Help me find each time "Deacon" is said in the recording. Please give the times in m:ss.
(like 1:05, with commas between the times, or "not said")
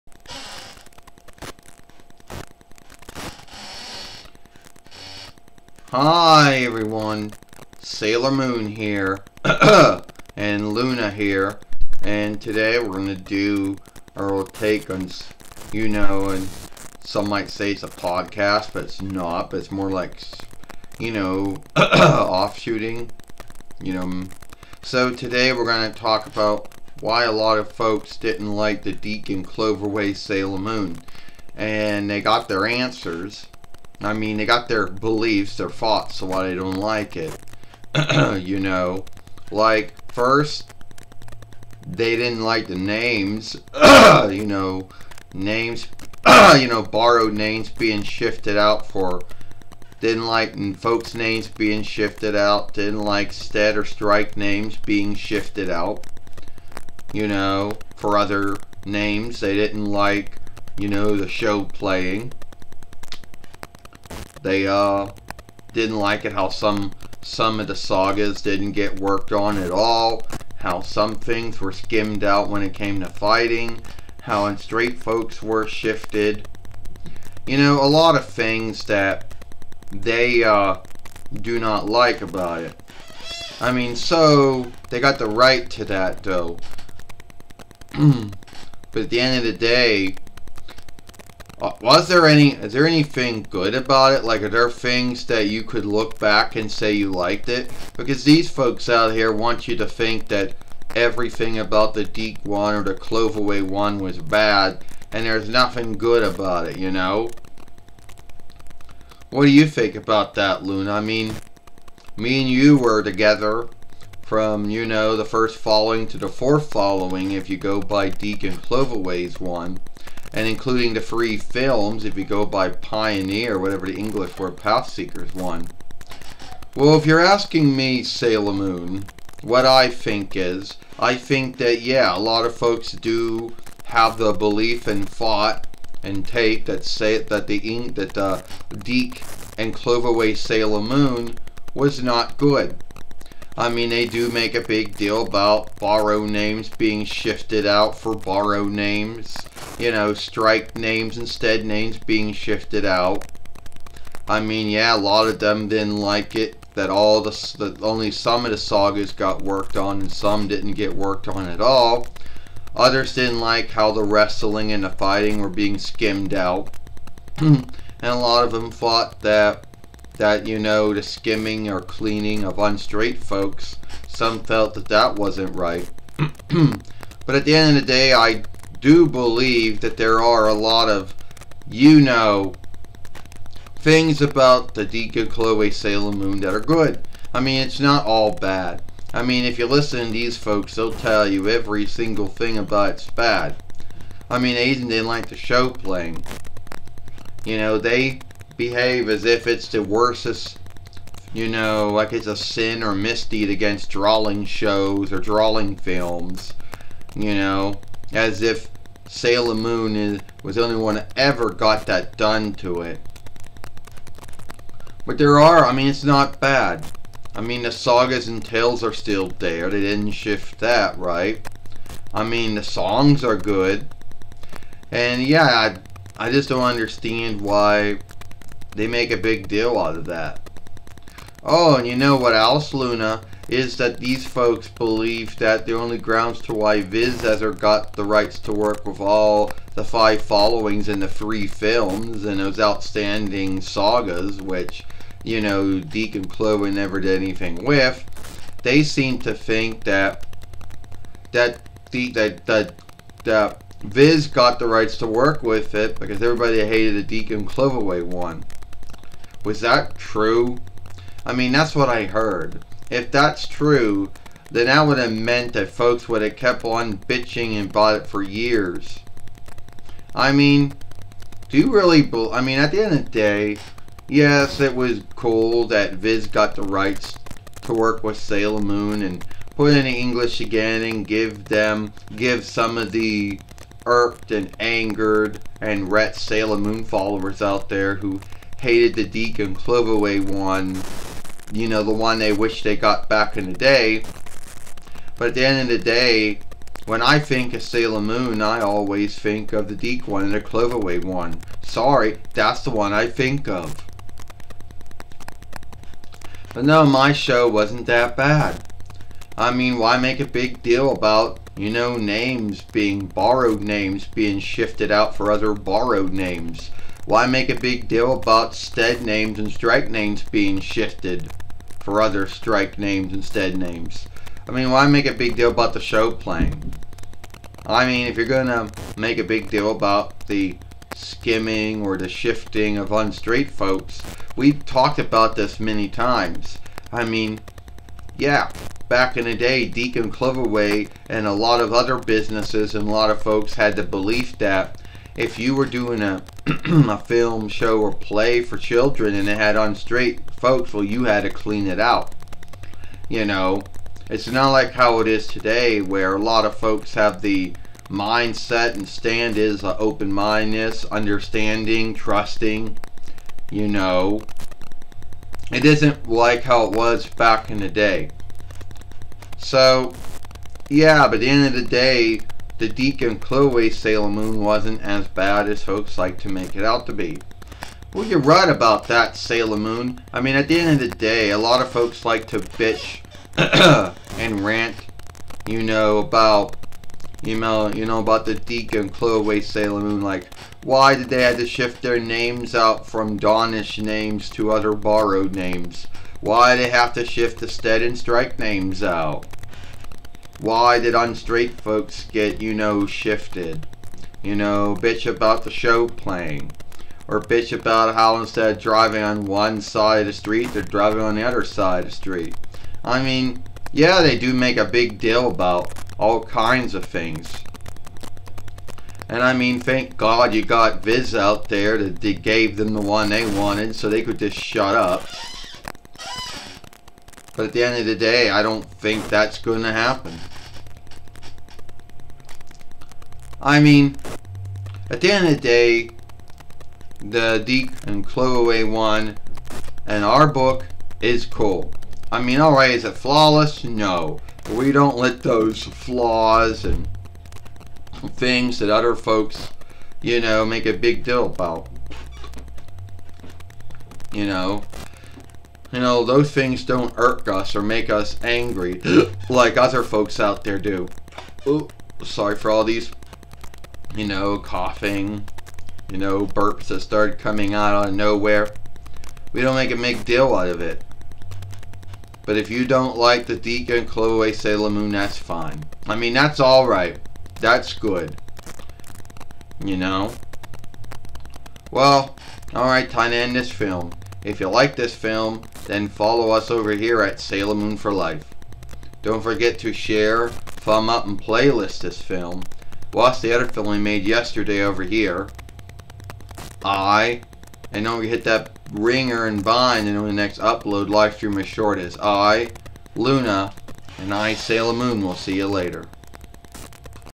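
0:28, 3:04, 4:05, 6:12, 6:28, 7:53.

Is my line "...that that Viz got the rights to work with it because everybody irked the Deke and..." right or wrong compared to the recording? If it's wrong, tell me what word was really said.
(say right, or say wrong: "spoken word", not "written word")
wrong: "hated", not "irked".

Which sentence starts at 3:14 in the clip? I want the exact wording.
I mean, Asian didn't like the show playing.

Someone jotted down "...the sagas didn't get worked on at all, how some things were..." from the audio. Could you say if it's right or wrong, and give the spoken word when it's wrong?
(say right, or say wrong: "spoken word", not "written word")
right.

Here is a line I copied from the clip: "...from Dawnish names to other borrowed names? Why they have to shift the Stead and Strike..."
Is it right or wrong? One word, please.
right.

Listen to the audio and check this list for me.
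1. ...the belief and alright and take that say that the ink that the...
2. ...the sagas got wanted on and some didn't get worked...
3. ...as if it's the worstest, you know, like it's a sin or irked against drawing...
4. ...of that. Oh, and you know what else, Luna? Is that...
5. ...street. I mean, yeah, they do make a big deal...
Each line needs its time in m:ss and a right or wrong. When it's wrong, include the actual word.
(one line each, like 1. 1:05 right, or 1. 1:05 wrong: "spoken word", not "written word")
1. 2:14 wrong: "thought", not "alright"
2. 2:38 wrong: "worked", not "wanted"
3. 3:19 wrong: "misdeed", not "irked"
4. 3:49 right
5. 6:51 right.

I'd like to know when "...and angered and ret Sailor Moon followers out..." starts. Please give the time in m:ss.
4:44.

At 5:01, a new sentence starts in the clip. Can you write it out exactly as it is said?
Sorry, that's the one I think of.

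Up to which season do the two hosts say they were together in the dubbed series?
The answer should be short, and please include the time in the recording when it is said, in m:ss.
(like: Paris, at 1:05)
4th, at 1:56.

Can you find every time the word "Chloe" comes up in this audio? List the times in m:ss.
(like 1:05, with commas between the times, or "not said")
3:05, 6:13, 6:28, 7:53.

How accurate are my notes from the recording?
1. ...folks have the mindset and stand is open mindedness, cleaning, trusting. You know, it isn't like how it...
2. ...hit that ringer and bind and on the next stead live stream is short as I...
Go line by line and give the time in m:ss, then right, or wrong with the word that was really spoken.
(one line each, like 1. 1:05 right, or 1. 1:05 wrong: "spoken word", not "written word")
1. 5:56 wrong: "understanding", not "cleaning"
2. 8:18 wrong: "upload", not "stead".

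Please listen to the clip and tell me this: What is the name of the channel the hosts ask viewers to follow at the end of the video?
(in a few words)
Sailor Moon for Life.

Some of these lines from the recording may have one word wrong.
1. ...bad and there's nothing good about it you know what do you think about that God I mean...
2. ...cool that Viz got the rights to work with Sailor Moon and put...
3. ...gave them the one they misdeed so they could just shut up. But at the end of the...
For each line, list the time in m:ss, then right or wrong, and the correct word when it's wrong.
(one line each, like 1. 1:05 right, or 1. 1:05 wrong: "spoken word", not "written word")
1. 1:44 wrong: "Luna", not "God"
2. 4:35 right
3. 7:02 wrong: "wanted", not "misdeed".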